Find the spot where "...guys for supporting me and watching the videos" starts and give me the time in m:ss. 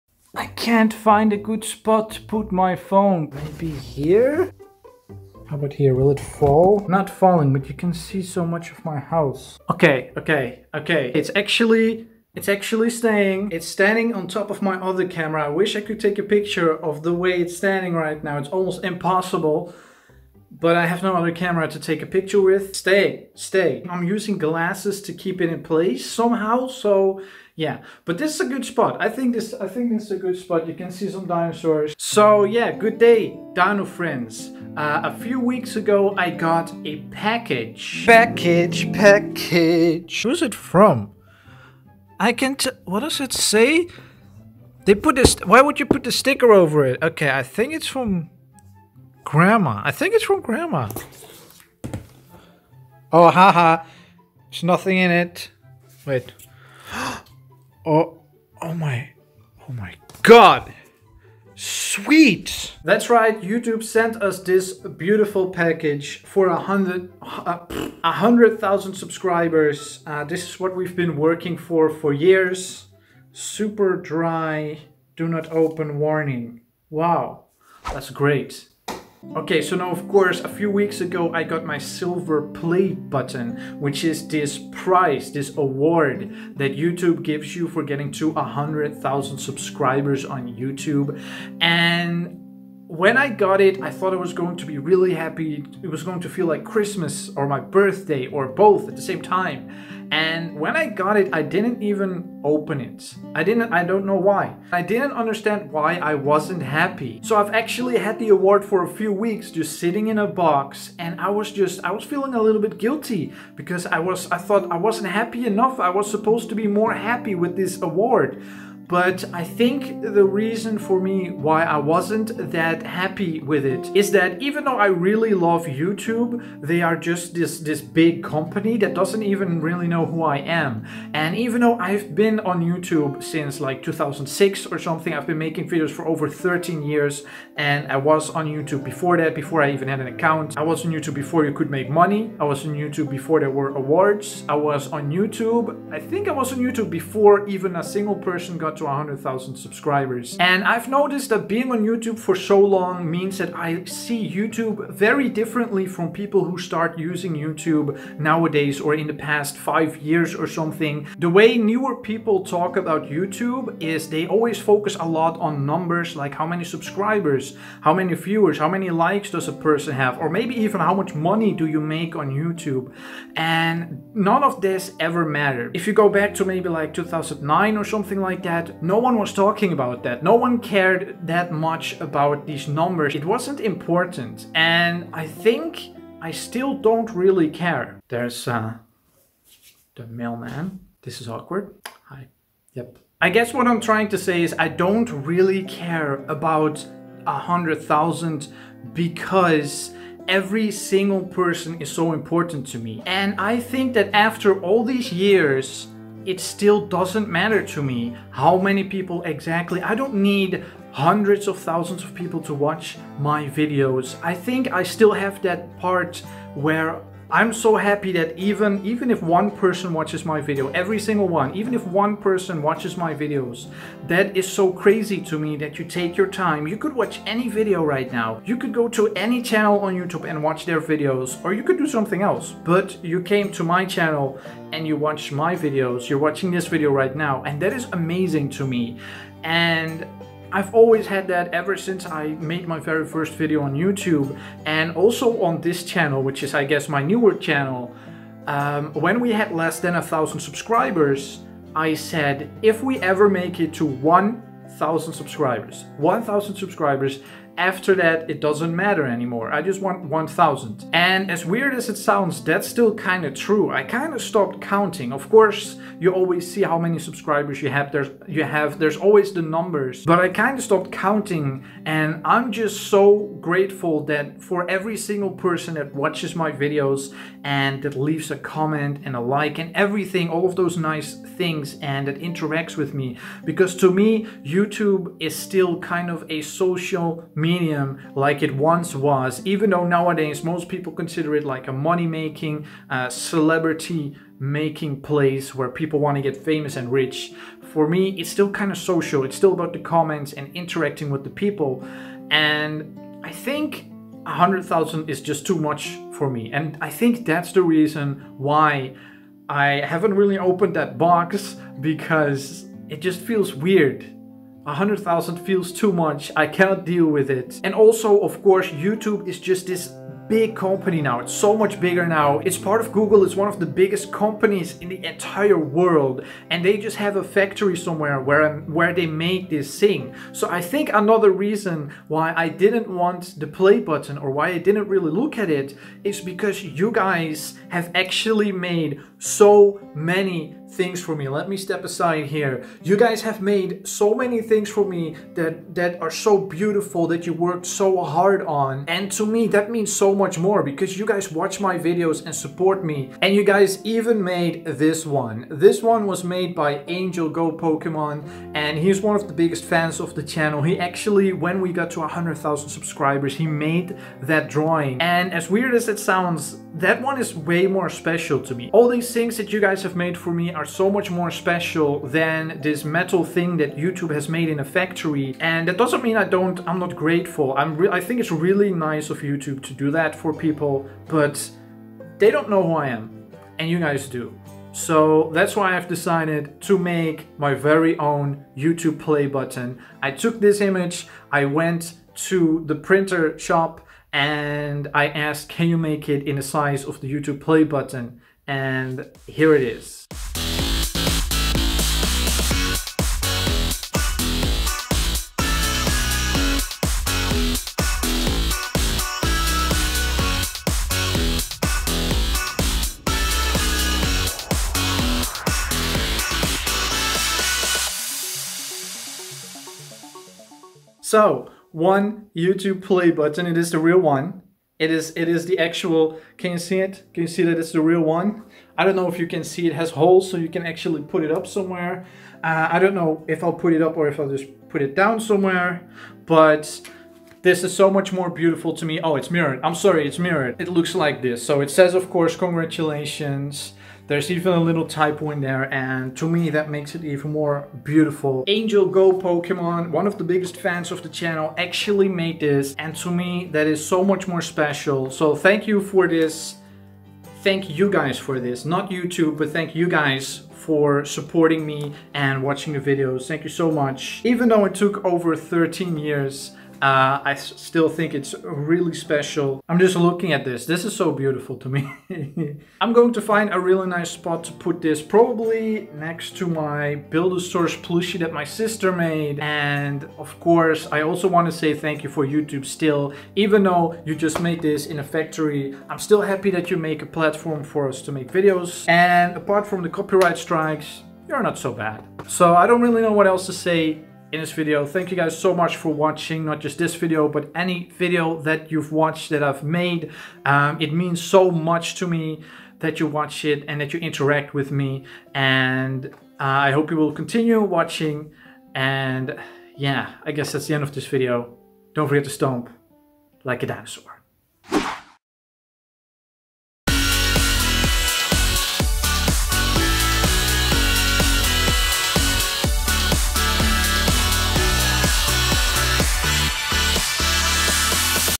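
7:39.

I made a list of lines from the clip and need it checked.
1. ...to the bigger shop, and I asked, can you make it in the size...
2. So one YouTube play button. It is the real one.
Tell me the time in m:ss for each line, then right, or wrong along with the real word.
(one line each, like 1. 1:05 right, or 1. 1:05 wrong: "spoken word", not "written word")
1. 6:32 wrong: "printer", not "bigger"
2. 7:01 right.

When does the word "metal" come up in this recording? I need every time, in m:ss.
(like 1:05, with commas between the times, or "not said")
6:12.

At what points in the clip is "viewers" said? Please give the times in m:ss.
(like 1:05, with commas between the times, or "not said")
2:48.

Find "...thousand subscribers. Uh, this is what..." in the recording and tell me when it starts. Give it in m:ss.
1:08.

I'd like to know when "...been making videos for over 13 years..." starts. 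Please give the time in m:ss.
2:15.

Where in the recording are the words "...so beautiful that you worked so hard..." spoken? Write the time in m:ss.
5:46.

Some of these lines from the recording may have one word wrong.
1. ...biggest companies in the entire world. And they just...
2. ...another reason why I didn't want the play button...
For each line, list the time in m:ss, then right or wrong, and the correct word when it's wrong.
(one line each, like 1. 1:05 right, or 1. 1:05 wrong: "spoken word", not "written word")
1. 5:23 right
2. 5:30 right.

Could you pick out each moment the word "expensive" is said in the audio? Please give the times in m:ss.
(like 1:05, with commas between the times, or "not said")
not said.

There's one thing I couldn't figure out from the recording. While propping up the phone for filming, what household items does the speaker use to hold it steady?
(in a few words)
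glasses.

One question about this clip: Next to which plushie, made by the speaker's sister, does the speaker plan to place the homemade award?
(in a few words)
Buildosaurus.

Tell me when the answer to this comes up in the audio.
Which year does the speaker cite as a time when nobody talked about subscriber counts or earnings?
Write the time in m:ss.
2:56.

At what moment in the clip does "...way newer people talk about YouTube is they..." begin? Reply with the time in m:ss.
2:41.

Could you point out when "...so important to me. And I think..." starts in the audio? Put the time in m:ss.
3:21.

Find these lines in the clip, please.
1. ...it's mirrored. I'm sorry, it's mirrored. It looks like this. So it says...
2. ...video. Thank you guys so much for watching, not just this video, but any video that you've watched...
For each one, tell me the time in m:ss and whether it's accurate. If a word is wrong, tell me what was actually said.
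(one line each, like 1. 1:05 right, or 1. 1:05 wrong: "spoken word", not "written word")
1. 7:19 right
2. 8:14 right.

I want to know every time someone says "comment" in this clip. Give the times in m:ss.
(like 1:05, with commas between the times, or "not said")
4:38, 4:59.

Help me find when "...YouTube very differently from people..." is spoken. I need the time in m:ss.
2:34.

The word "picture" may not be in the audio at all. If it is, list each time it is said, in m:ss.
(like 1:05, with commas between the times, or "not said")
0:16, 0:22.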